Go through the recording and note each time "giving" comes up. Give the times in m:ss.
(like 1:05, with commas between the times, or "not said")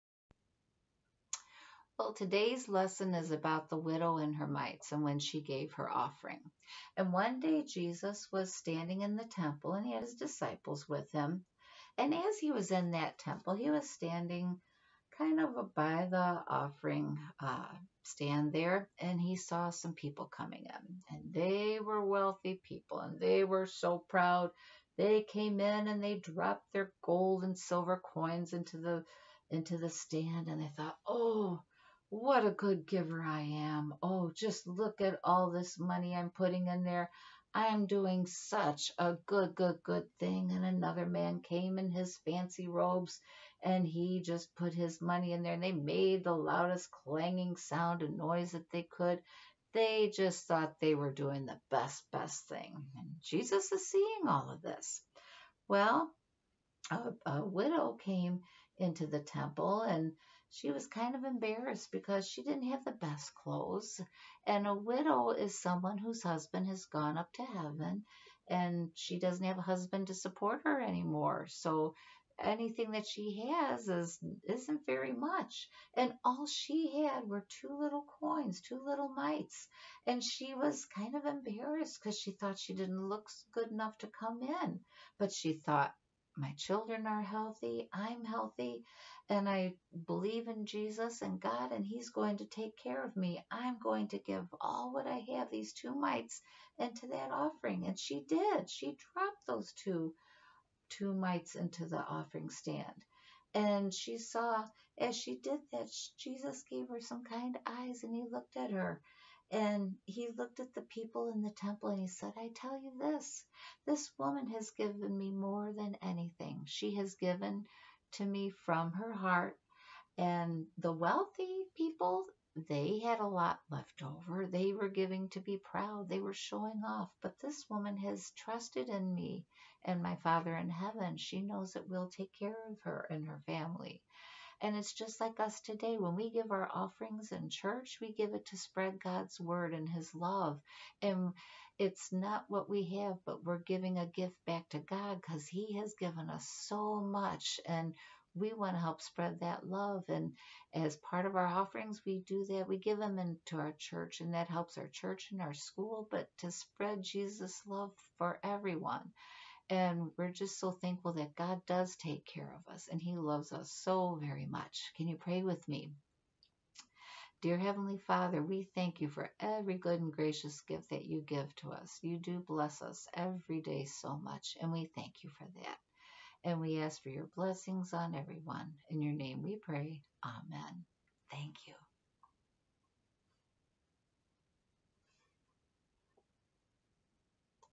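2:04, 2:23.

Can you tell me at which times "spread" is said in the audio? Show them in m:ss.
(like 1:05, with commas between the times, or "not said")
2:18, 2:29, 2:36.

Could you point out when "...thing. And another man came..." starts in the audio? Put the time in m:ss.
0:40.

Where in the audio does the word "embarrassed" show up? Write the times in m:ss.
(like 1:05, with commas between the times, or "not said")
1:01, 1:21.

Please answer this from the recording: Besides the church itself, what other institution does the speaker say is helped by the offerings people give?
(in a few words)
our school.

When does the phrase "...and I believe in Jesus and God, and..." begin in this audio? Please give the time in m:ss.
1:29.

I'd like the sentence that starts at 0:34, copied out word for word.
Oh, just look at all this money I'm putting in there.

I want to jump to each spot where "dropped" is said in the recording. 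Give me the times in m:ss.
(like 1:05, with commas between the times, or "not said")
0:26, 1:39.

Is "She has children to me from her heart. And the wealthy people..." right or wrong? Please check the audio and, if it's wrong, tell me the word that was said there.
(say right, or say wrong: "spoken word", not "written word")
wrong: "given", not "children".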